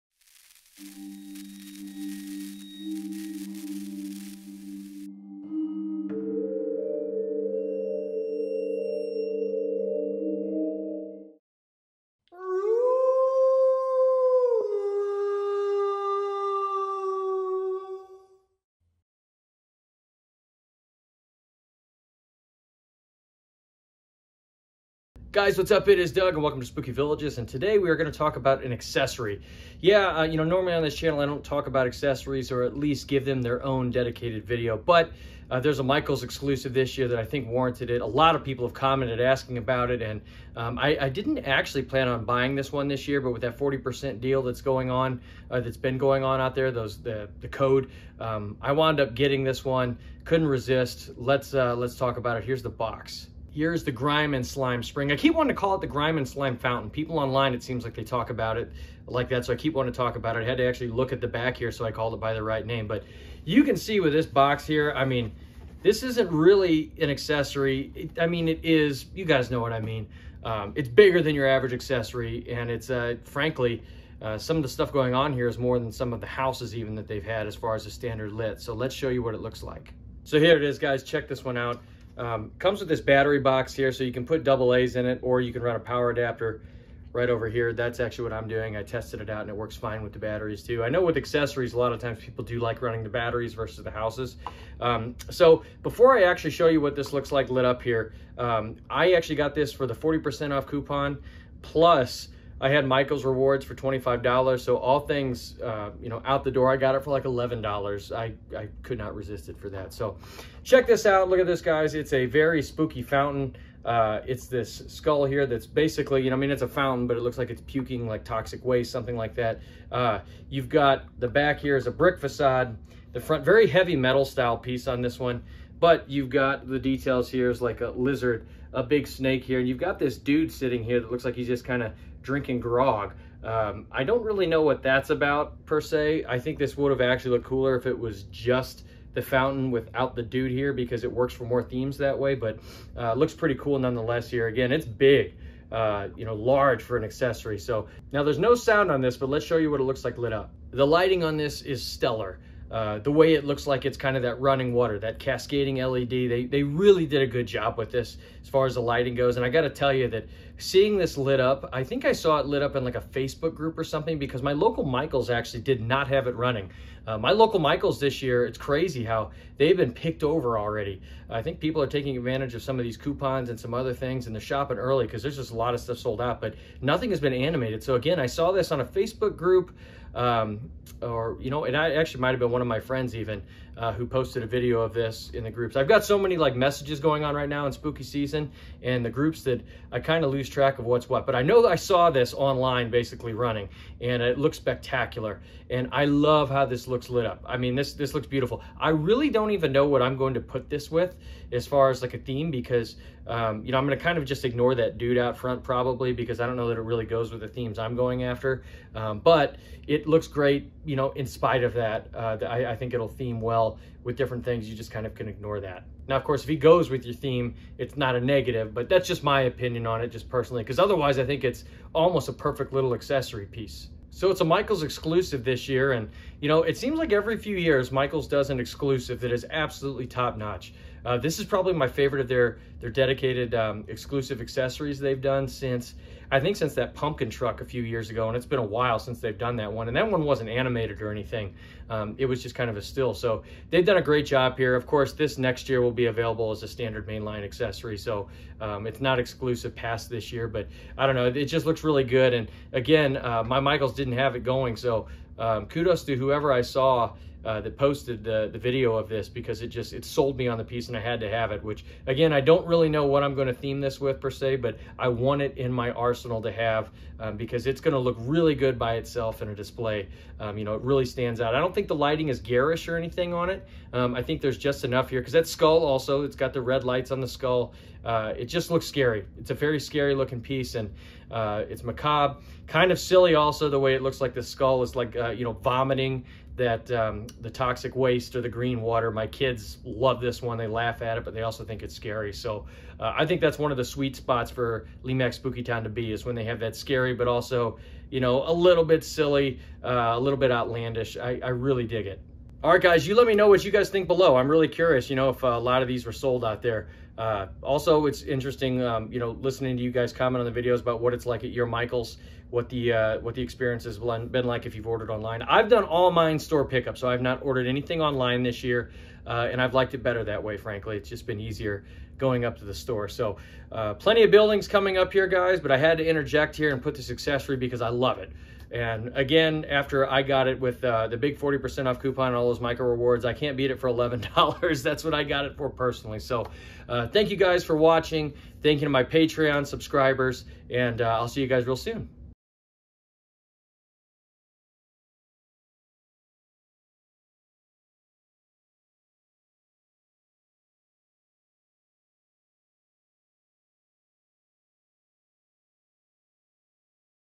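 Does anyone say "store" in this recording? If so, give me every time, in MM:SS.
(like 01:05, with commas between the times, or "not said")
05:16, 05:22.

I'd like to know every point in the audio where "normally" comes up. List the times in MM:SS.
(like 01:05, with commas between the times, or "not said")
00:30.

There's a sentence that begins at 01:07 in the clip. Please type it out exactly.
It, I mean, it is, you guys know what I mean.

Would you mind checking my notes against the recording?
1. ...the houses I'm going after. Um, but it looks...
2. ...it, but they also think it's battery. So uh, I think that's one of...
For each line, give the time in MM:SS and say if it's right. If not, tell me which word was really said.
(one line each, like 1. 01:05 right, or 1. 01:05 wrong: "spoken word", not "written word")
1. 03:27 wrong: "themes", not "houses"
2. 04:51 wrong: "scary", not "battery".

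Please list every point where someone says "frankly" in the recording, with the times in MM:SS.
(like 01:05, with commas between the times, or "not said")
01:13, 05:20.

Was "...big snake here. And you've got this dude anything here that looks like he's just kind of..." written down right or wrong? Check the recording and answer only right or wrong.
wrong.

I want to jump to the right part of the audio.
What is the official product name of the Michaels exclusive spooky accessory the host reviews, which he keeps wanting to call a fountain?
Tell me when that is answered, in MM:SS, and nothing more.
00:53.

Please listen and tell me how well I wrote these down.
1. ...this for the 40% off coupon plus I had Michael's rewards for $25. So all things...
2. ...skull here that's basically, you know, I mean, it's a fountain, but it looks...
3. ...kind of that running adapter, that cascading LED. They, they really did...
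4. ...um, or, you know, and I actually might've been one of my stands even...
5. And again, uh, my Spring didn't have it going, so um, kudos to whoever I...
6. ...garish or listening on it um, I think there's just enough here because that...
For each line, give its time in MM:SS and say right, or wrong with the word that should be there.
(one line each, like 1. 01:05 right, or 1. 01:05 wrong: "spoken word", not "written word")
1. 01:39 right
2. 01:54 right
3. 02:33 wrong: "water", not "adapter"
4. 03:00 wrong: "friends", not "stands"
5. 04:12 wrong: "Michaels", not "Spring"
6. 04:32 wrong: "anything", not "listening".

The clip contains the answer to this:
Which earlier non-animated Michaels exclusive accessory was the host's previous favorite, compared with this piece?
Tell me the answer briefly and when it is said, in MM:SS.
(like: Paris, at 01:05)
Pumpkin truck, at 03:56.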